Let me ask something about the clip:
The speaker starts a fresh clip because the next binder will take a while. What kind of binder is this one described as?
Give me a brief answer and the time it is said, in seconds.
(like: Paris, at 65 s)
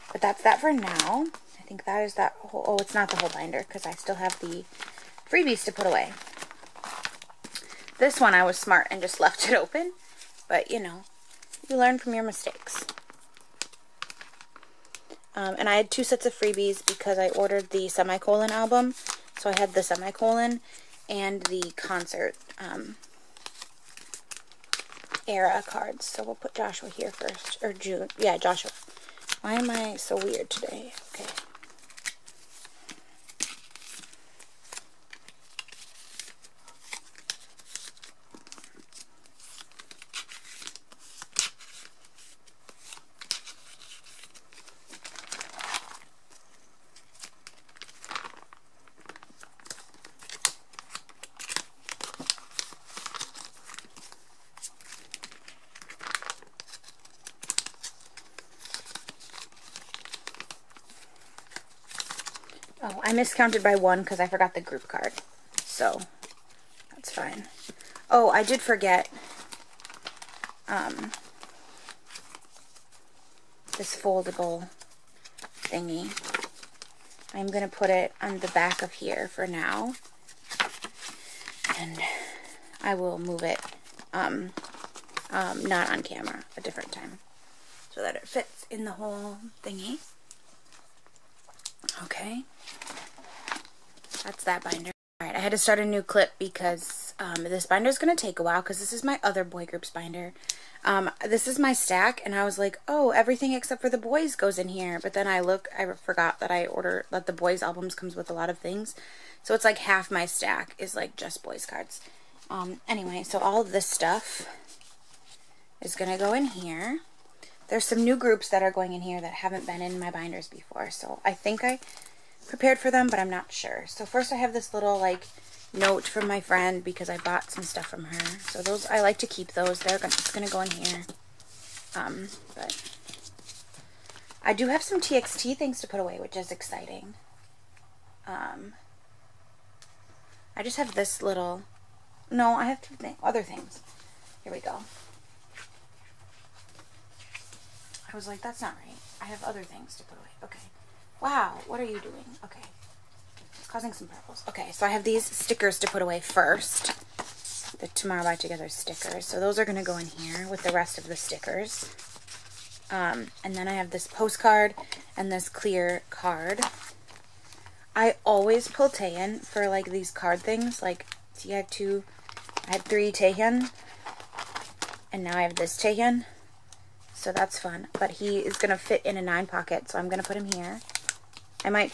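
other boy groups binder, at 99 s.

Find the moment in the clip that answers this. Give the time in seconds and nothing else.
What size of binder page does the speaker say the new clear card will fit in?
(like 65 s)
179 s.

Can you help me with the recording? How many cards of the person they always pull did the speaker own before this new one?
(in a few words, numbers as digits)
3.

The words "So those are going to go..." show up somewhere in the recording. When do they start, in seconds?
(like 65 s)
159 s.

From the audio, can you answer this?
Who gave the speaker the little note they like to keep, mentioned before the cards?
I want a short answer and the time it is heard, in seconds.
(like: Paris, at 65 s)
my friend, at 126 s.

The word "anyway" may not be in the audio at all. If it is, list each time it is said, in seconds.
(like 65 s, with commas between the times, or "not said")
112 s.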